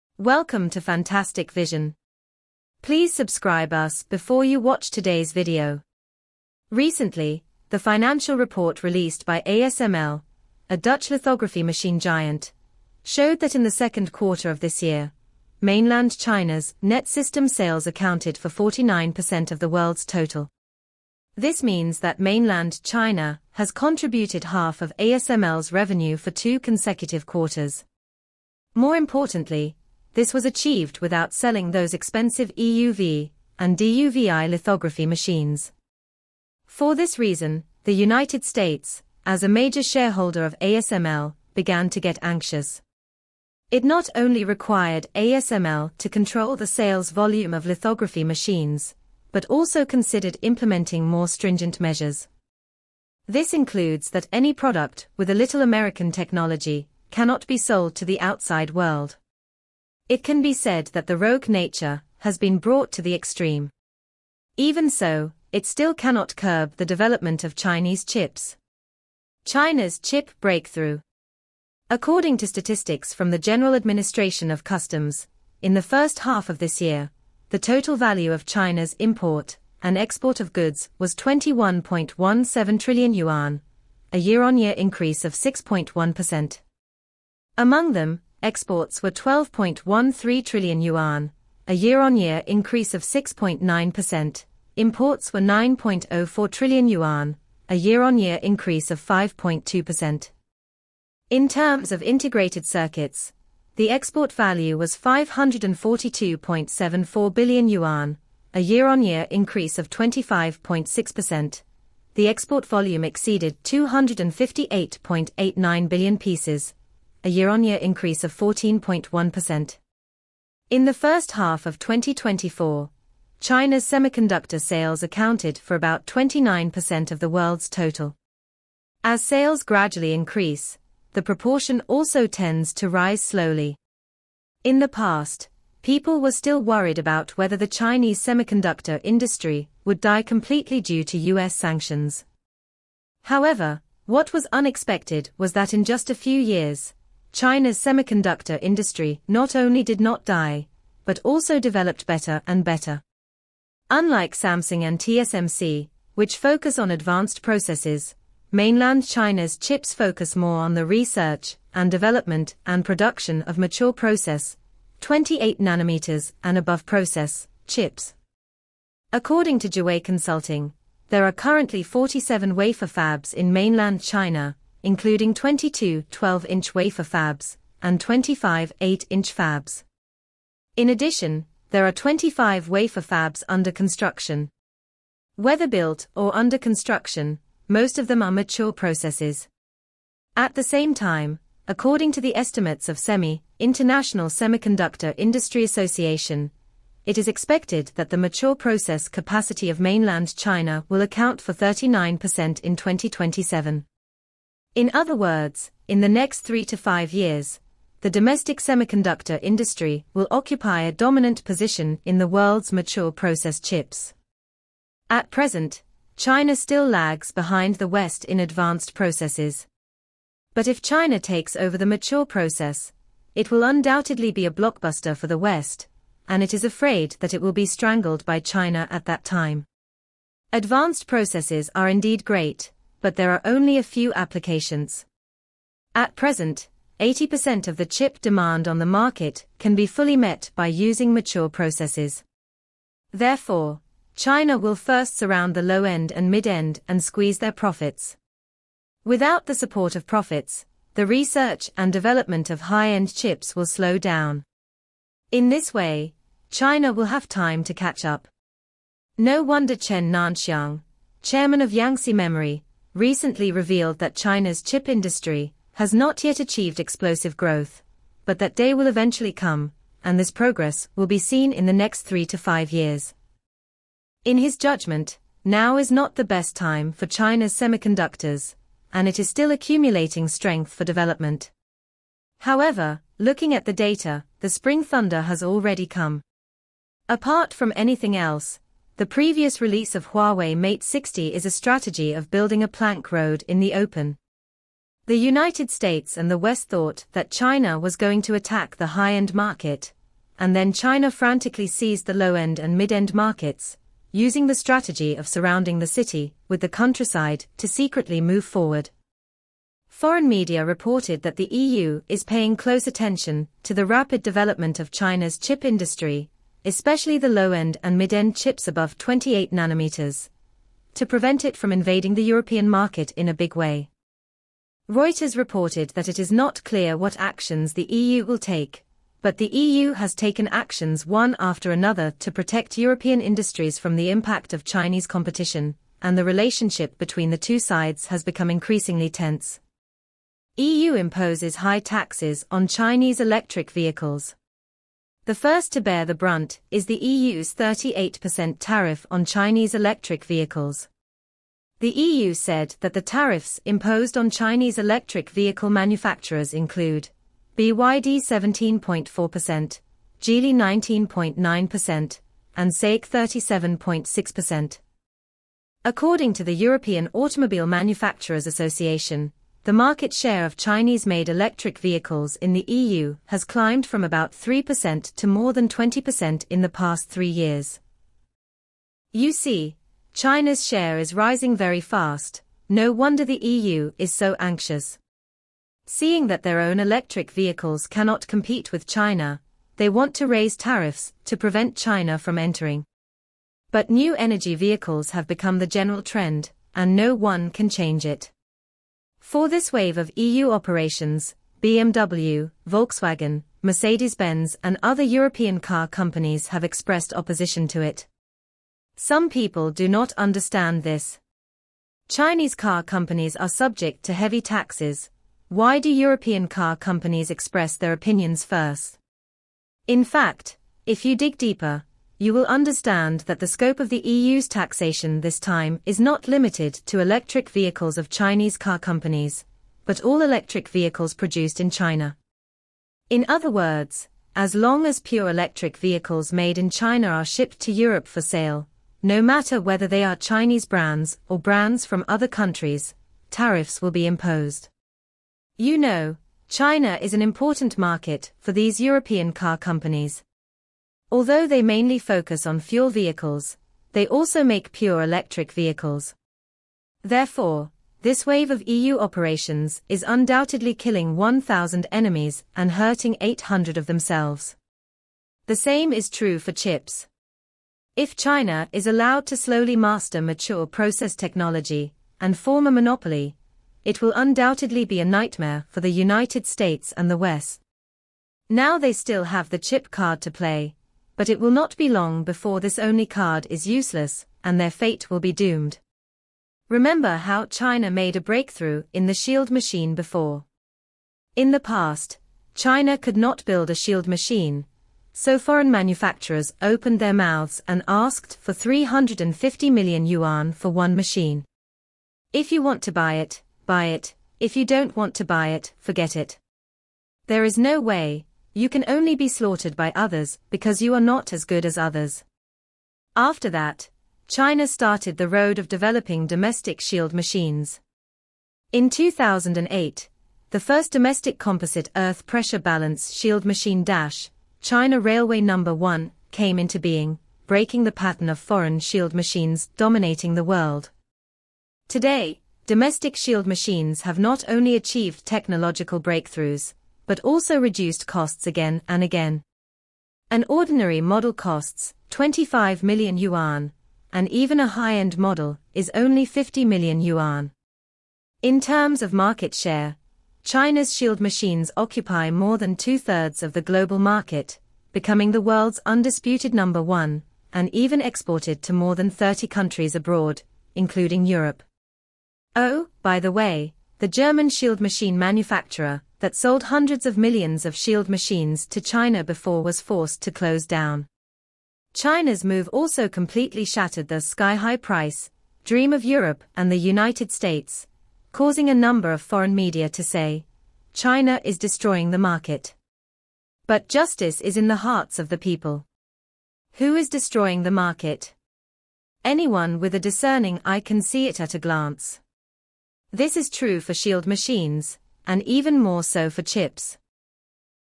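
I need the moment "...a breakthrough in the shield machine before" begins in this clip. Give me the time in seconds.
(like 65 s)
488 s.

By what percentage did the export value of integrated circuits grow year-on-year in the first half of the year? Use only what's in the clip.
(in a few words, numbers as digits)
25.6%.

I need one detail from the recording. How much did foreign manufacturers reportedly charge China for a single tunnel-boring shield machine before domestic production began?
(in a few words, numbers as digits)
350 million yuan.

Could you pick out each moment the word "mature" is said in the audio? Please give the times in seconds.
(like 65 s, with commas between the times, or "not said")
163 s, 188 s, 198 s, 212 s, 221 s, 241 s, 470 s.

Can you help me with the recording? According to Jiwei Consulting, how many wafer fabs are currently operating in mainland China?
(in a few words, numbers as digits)
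47.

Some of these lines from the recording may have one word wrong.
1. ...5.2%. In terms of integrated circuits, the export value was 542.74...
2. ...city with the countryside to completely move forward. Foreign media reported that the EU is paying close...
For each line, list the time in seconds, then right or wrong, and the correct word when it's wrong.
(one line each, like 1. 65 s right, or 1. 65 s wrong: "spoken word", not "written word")
1. 98 s right
2. 305 s wrong: "secretly", not "completely".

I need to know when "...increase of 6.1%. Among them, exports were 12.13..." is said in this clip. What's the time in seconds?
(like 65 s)
84 s.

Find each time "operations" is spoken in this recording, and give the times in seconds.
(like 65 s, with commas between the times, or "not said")
400 s, 458 s.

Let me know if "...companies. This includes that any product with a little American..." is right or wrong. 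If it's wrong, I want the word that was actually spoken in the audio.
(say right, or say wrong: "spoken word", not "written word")
wrong: "measures", not "companies".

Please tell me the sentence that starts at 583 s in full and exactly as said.
But justice is in the hearts of the people.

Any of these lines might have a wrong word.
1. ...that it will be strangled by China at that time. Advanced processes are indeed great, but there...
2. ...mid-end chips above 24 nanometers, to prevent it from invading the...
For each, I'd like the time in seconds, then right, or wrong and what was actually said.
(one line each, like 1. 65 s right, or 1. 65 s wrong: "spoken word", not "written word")
1. 227 s right
2. 317 s wrong: "28", not "24".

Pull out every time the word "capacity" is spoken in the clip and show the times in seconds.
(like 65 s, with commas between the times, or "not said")
199 s.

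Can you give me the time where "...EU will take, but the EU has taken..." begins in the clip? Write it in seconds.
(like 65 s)
327 s.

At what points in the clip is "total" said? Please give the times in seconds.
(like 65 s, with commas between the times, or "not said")
20 s, 77 s, 127 s.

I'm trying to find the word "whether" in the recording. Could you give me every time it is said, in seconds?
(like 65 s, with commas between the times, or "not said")
137 s, 185 s, 439 s.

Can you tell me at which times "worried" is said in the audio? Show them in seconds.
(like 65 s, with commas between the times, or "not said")
136 s.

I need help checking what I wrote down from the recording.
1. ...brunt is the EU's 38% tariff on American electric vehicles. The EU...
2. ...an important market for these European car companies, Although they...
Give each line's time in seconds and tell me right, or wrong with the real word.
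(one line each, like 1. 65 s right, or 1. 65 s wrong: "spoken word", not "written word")
1. 346 s wrong: "Chinese", not "American"
2. 447 s right.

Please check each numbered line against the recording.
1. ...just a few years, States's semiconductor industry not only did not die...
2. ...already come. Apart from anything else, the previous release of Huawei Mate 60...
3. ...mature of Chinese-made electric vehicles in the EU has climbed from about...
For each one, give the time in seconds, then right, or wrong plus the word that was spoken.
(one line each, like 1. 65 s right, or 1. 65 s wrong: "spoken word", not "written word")
1. 145 s wrong: "China", not "States"
2. 285 s right
3. 370 s wrong: "share", not "mature".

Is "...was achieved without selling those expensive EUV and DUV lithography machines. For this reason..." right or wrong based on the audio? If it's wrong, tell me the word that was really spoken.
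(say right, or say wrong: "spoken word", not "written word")
right.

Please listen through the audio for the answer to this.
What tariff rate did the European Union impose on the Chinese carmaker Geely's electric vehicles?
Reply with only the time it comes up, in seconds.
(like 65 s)
360 s.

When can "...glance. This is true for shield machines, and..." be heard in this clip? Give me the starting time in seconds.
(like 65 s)
591 s.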